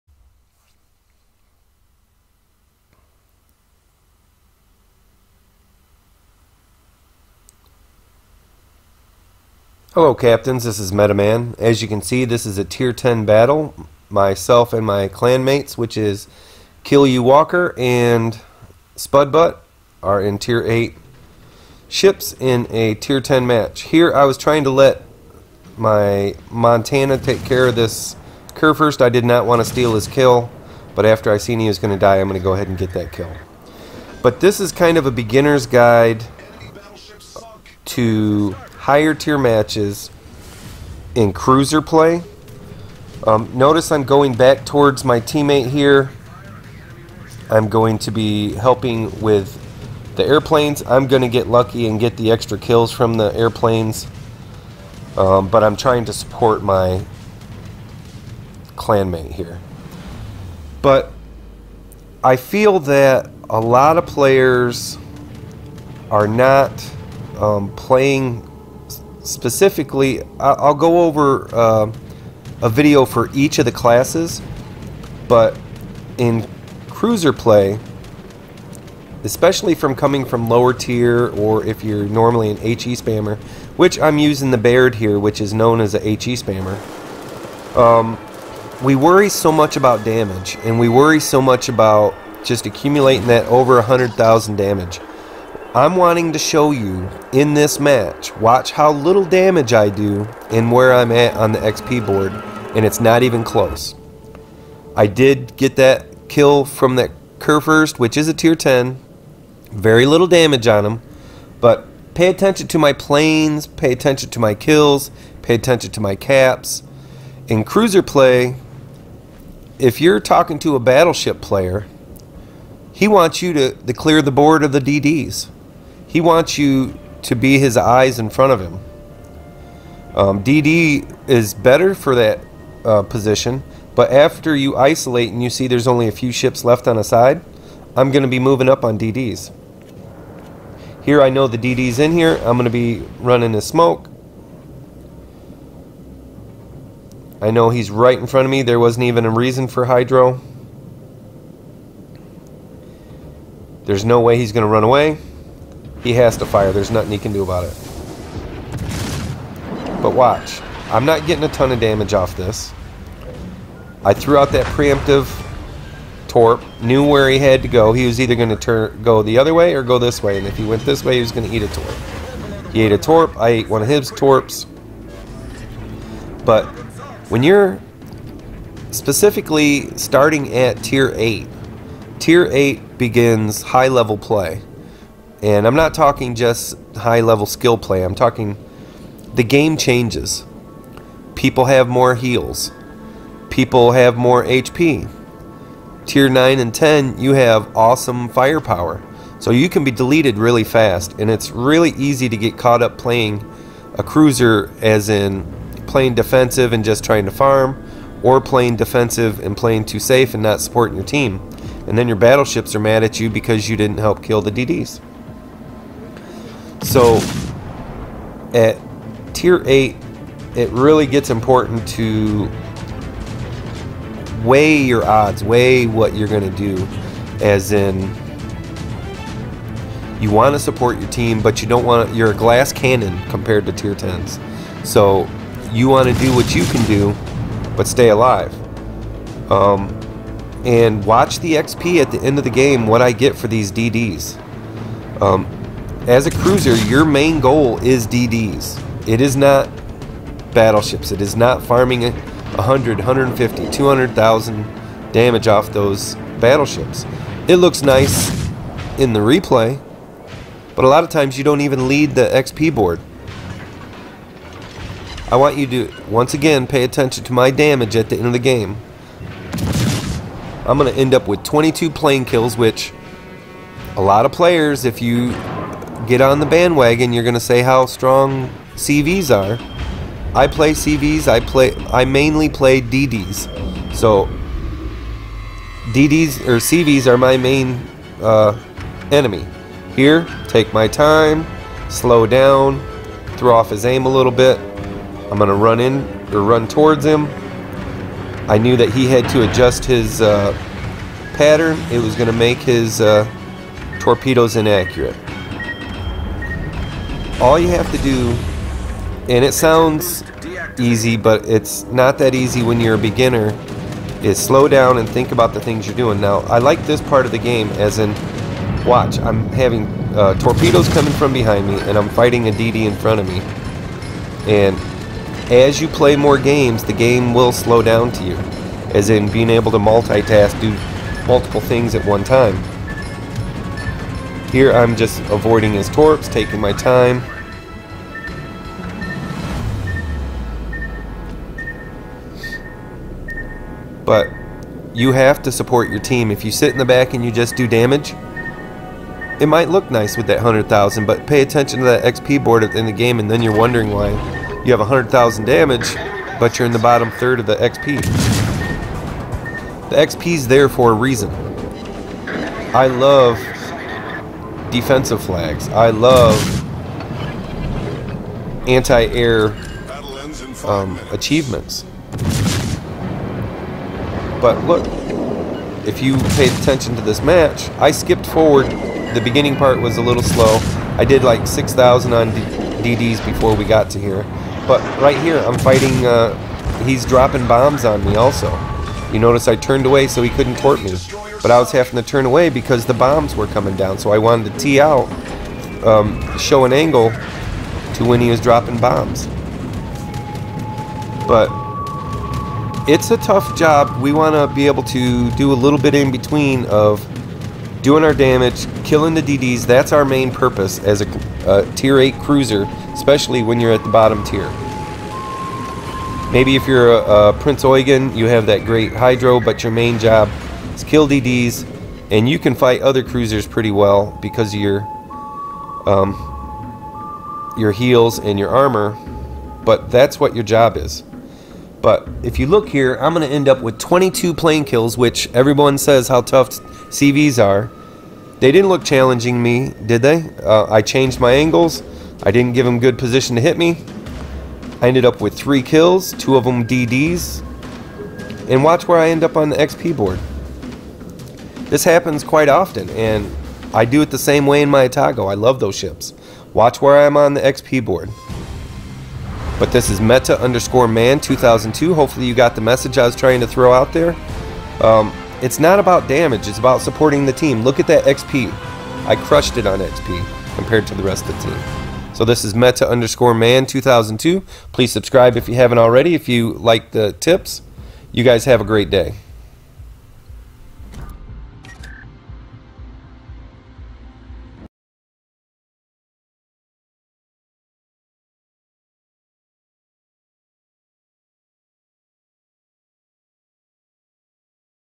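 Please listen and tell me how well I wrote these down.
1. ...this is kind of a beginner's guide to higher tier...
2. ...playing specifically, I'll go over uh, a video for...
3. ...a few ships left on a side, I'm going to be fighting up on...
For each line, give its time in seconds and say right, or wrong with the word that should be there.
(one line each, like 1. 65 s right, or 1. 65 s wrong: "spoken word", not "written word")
1. 34 s right
2. 67 s right
3. 136 s wrong: "moving", not "fighting".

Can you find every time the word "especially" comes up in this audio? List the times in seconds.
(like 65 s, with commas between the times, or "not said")
79 s, 412 s.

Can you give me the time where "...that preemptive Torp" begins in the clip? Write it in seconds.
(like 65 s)
164 s.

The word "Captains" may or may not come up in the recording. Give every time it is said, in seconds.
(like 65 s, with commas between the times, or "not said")
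10 s.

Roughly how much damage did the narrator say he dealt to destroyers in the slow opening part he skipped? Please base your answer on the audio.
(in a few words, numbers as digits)
6,000.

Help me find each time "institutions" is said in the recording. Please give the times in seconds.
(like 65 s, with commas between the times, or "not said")
not said.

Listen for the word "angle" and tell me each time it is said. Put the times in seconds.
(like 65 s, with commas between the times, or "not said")
396 s, 441 s.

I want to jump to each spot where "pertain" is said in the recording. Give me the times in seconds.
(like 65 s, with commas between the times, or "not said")
not said.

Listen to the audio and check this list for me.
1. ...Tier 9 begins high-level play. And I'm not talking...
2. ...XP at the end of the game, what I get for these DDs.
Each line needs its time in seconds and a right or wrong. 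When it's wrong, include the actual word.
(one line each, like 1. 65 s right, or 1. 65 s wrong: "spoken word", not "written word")
1. 182 s wrong: "8", not "9"
2. 241 s right.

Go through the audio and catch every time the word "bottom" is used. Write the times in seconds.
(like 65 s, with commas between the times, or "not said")
356 s, 413 s.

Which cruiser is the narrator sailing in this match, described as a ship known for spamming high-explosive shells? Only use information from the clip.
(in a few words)
Baird.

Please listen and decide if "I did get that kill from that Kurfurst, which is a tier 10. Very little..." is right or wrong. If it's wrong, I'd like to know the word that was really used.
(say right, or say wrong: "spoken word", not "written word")
right.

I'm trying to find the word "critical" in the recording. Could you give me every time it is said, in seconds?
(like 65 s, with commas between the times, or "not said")
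not said.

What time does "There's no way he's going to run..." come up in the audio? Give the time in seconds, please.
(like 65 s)
153 s.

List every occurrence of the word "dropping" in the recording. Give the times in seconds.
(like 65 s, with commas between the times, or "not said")
387 s, 398 s.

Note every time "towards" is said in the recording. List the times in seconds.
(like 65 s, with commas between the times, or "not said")
44 s, 296 s.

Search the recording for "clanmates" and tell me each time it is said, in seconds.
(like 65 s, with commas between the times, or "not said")
15 s, 58 s.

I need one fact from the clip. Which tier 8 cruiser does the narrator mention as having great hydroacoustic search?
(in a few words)
Prinz Eugen.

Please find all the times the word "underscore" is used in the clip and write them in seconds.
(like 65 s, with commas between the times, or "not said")
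460 s, 472 s.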